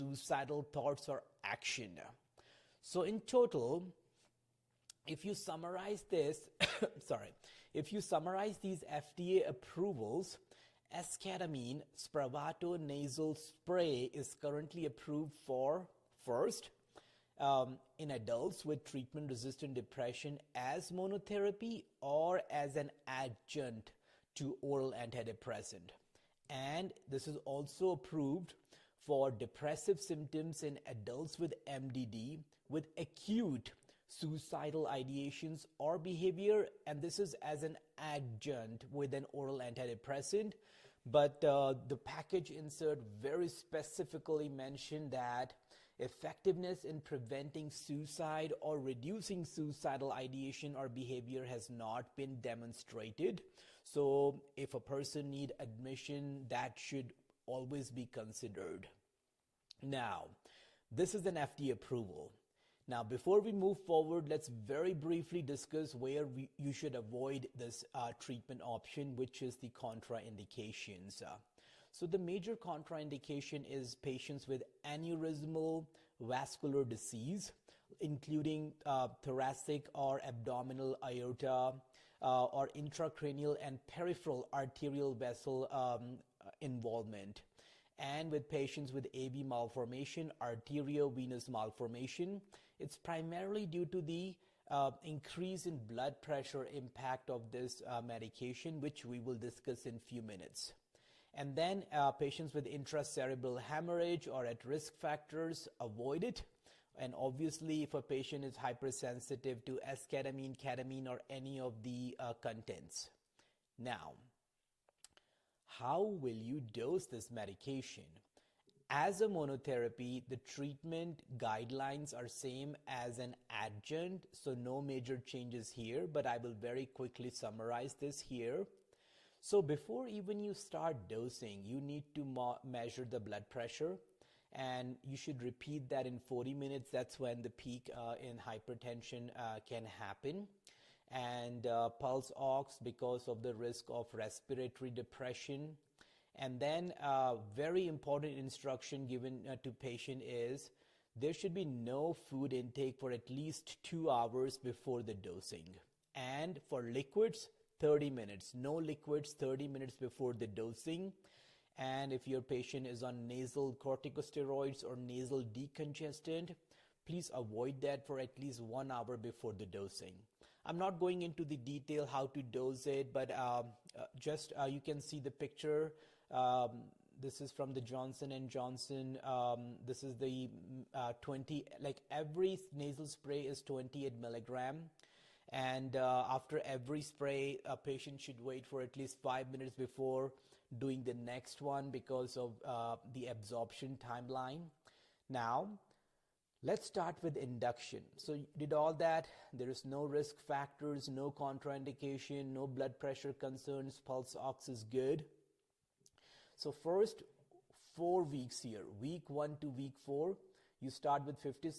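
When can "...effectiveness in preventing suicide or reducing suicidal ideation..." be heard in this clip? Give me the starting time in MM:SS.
00:45.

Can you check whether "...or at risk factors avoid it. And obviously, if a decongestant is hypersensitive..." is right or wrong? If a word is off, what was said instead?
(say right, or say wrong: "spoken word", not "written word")
wrong: "patient", not "decongestant".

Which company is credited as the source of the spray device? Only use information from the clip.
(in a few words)
Johnson and Johnson.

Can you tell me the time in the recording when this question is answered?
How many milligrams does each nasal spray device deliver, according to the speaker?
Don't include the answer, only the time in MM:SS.
03:03.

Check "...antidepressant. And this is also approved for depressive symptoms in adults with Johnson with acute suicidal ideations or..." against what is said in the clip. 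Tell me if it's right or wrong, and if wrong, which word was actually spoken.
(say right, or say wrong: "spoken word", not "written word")
wrong: "MDD", not "Johnson".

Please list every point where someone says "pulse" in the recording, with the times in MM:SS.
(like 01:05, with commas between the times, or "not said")
02:21, 03:24.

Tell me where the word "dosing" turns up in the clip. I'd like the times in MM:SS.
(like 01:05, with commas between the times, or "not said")
02:11, 02:35, 02:40, 02:49.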